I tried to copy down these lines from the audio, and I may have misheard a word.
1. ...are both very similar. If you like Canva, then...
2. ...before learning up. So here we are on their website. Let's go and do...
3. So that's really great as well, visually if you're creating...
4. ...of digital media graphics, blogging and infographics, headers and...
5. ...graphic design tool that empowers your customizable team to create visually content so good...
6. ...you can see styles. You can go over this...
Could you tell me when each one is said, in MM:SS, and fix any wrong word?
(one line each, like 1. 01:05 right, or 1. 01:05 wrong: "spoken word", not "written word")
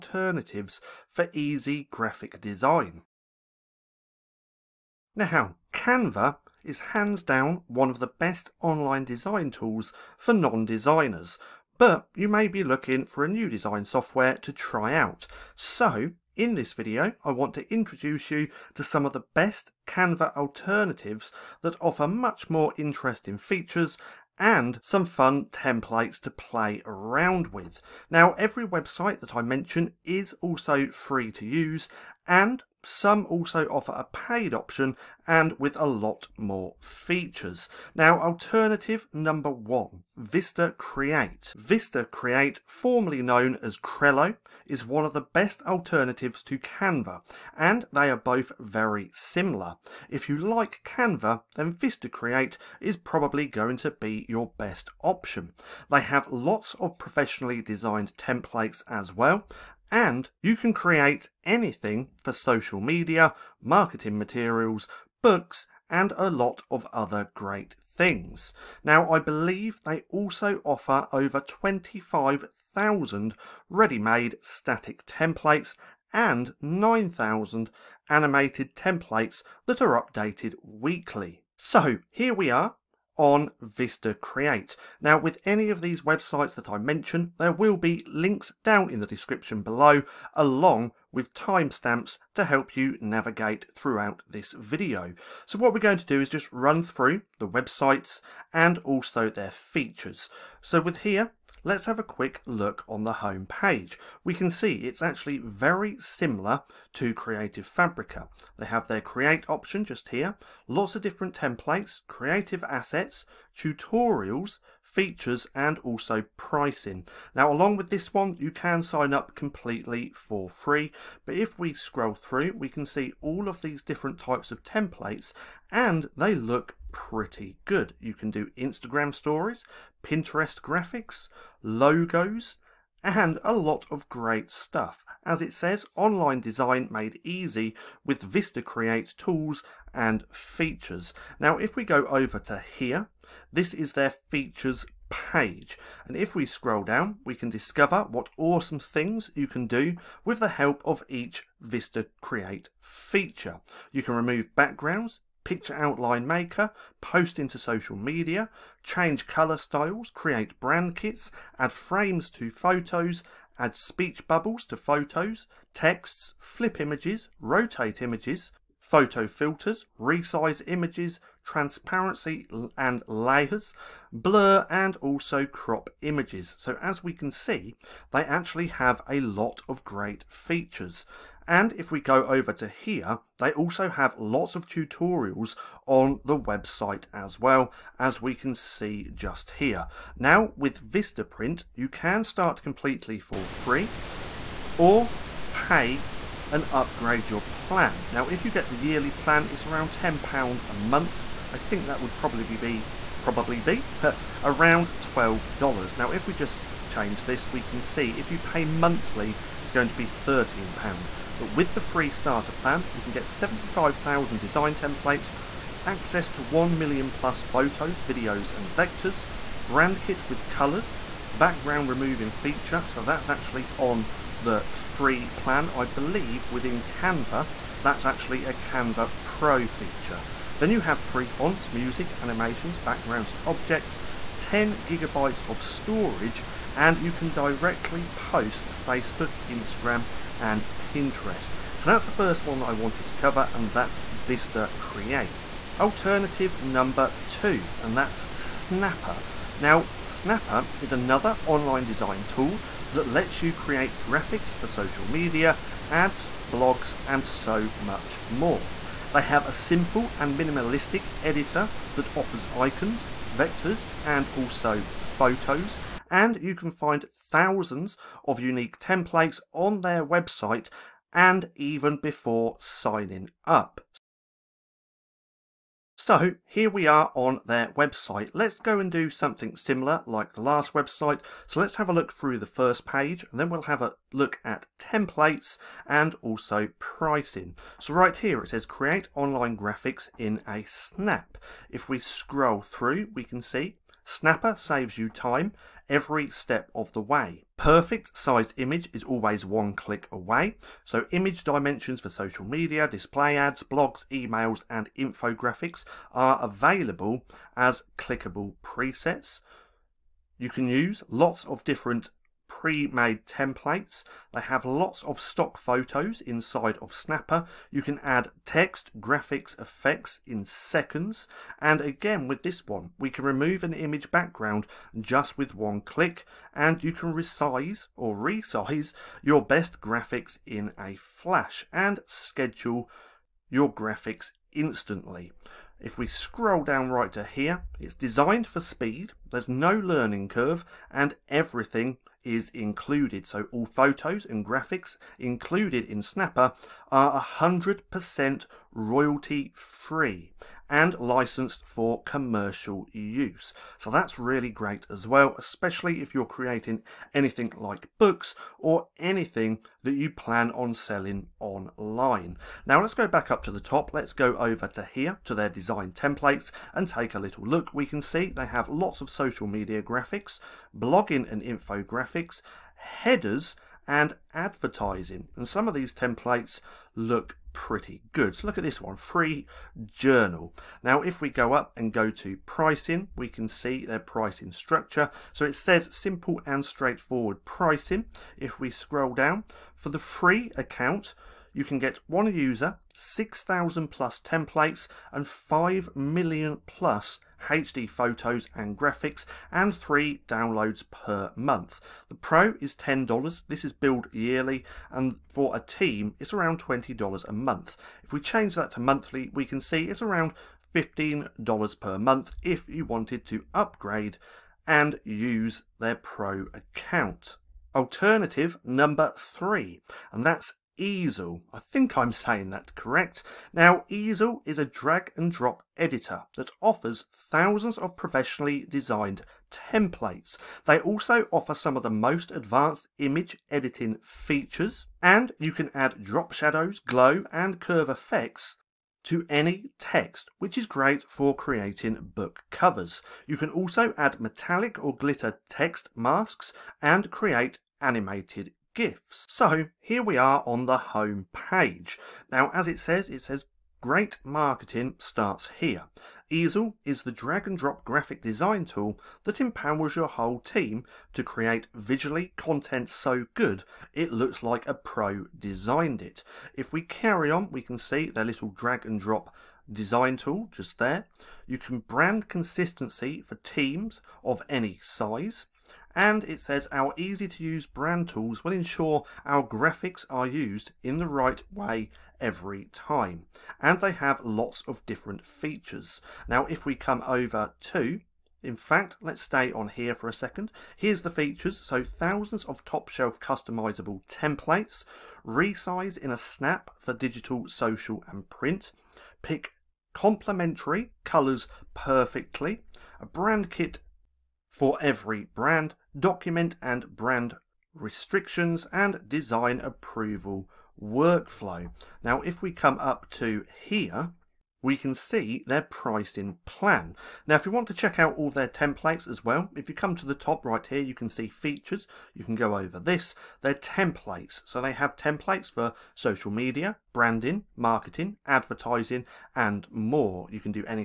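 1. 00:48 right
2. 04:31 wrong: "signing", not "learning"
3. 05:53 wrong: "especially", not "visually"
4. 06:09 wrong: "social", not "digital"
5. 07:37 wrong: "whole", not "customizable"
6. 08:40 wrong: "features", not "styles".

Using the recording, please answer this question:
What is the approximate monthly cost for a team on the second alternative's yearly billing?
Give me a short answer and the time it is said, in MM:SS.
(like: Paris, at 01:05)
$20, at 06:46.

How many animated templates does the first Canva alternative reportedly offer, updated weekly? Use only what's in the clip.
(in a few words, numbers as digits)
9,000.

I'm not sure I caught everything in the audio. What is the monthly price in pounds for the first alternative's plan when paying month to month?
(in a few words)
£13.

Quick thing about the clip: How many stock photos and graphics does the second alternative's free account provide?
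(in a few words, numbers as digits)
5 million plus.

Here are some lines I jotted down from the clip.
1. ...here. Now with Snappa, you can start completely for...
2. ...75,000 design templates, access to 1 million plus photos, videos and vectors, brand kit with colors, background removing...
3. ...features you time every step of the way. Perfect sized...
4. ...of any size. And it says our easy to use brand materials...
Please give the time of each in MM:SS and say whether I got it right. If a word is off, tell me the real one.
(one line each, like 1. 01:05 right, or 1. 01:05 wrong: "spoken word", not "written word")
1. 03:09 wrong: "Vistaprint", not "Snappa"
2. 03:33 right
3. 04:54 wrong: "saves", not "features"
4. 07:54 wrong: "tools", not "materials".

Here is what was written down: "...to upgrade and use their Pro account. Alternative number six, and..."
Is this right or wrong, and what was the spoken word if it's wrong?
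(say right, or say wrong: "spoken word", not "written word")
wrong: "three", not "six".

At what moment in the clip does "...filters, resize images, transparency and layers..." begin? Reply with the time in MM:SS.
02:49.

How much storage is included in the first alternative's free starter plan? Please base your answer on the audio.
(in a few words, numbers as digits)
10 gigabytes.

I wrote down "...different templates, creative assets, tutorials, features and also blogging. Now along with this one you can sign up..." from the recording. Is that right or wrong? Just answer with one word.
wrong.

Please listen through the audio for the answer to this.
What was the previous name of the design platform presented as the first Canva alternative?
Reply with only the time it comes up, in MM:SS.
00:43.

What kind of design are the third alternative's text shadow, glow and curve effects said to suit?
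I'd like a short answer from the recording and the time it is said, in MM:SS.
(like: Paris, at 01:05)
book covers, at 07:22.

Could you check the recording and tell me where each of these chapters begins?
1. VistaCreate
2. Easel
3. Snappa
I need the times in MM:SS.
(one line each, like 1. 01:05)
1. 00:37
2. 06:57
3. 04:05.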